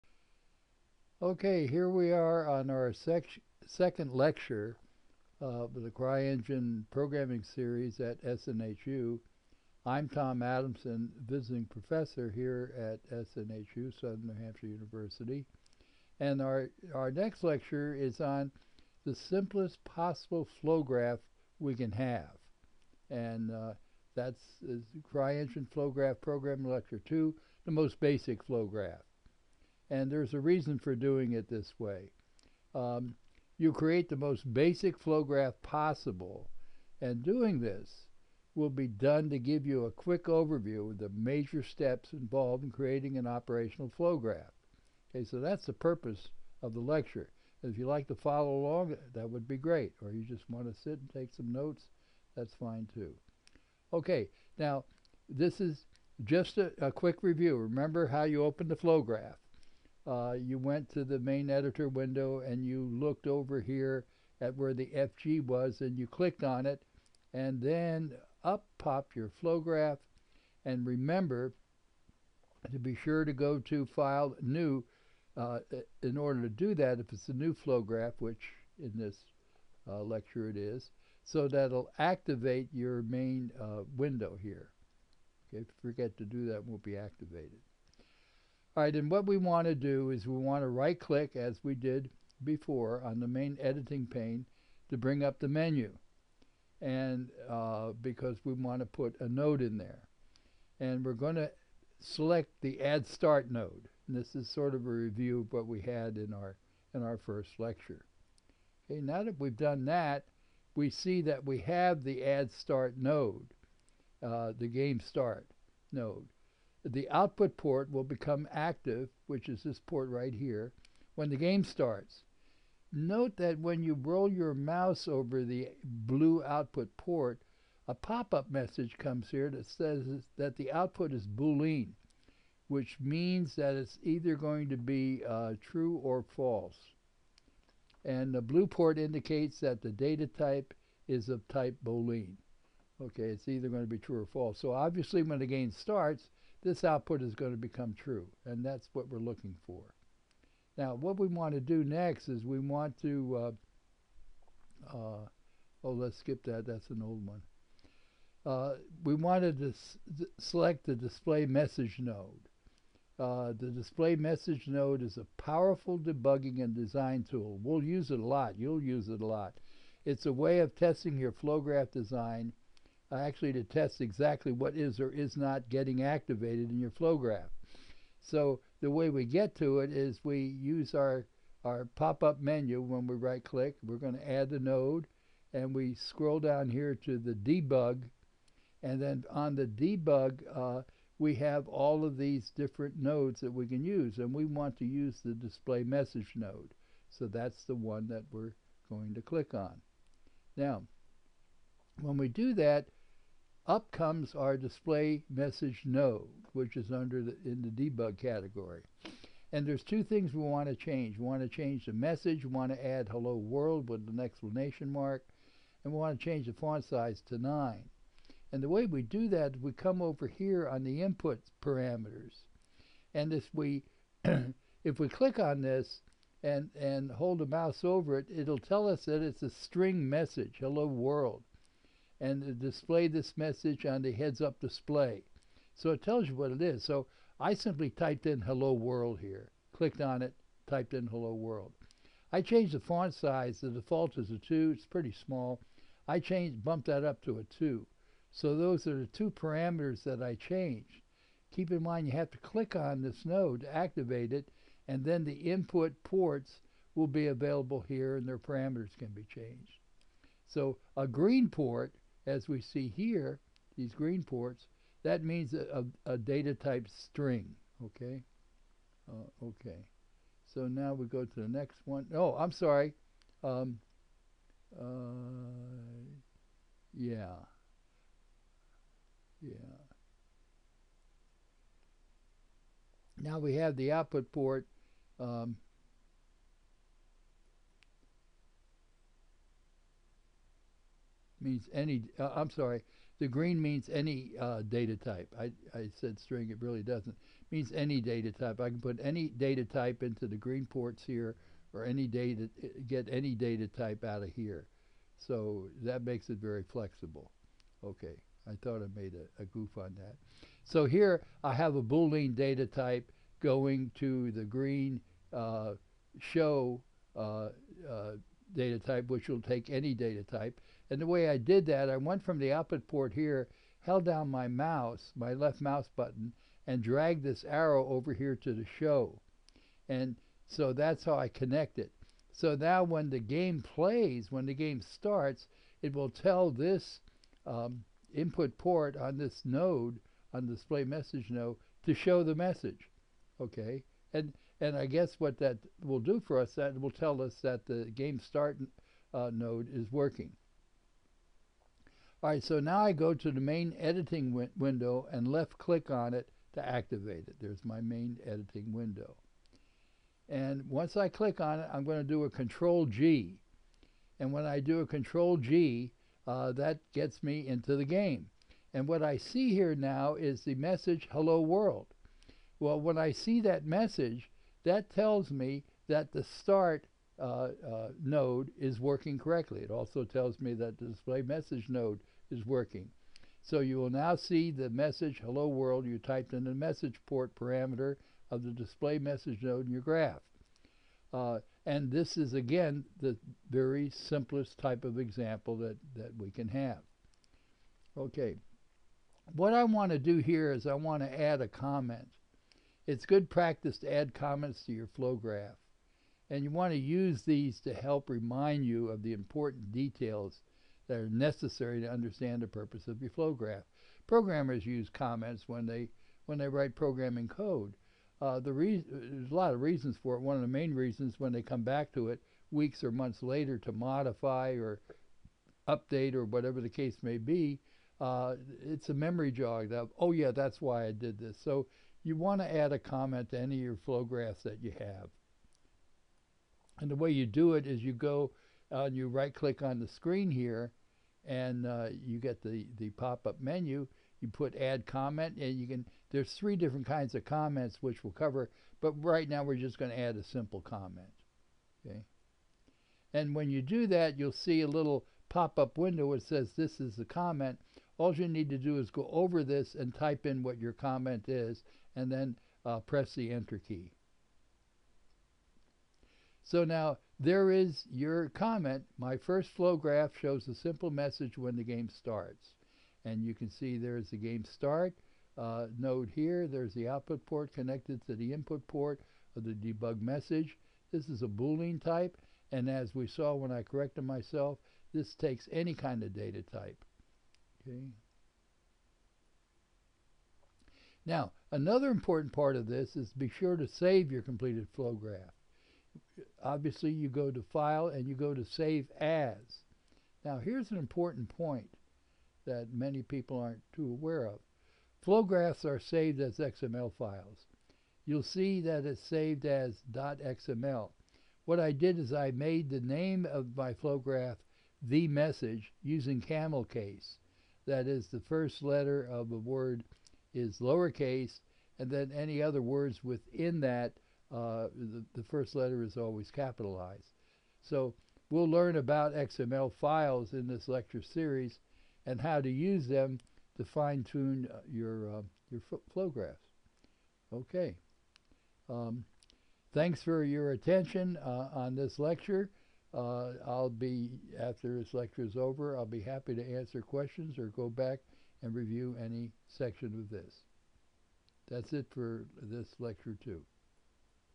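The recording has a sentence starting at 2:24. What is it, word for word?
So obviously when the game starts, this output is going to become true, and that's what we're looking for.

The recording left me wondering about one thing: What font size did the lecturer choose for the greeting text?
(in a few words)
9.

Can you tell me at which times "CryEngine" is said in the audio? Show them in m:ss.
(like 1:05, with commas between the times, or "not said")
0:05, 0:25.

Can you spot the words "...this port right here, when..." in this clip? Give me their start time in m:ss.
1:59.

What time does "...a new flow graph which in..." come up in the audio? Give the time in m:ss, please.
1:17.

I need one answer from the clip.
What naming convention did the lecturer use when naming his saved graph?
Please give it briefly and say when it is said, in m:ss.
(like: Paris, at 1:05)
camel case, at 8:36.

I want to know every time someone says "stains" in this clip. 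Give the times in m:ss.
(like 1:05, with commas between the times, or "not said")
not said.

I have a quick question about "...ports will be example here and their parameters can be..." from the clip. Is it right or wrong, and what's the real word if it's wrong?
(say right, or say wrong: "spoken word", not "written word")
wrong: "available", not "example".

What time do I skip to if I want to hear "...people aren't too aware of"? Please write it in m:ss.
8:23.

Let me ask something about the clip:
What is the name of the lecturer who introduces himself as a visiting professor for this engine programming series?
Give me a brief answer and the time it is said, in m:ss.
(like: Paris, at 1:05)
Tom Adamson, at 0:10.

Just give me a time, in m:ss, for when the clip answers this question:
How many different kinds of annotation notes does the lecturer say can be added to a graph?
7:26.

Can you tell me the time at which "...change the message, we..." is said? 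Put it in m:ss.
3:31.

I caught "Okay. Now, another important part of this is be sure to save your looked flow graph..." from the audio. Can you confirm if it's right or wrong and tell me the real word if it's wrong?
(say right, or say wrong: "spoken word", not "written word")
wrong: "completed", not "looked".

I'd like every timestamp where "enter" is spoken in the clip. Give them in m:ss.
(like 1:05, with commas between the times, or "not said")
7:43.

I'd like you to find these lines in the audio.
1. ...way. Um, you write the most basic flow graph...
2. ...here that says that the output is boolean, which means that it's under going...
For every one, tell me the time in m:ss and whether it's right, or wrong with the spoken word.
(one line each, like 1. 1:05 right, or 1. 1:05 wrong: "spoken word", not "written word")
1. 0:31 wrong: "create", not "write"
2. 2:09 wrong: "either", not "under".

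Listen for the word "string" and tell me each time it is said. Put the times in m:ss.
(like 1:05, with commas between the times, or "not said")
3:49, 4:26, 4:56.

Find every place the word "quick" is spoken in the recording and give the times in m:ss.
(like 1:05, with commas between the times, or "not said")
0:39, 0:56.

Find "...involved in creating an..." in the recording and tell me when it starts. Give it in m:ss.
0:42.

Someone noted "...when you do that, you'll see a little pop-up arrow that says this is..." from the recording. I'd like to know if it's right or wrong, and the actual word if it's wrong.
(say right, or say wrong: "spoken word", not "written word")
wrong: "window", not "arrow".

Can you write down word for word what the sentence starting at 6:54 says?
Programmers use comments when they when they write programming code.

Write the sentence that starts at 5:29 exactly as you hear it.
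And so that's how I connect it.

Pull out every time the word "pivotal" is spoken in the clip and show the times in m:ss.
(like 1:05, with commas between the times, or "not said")
not said.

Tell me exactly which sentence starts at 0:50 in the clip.
Or you just want to sit and take some notes, that's fine too.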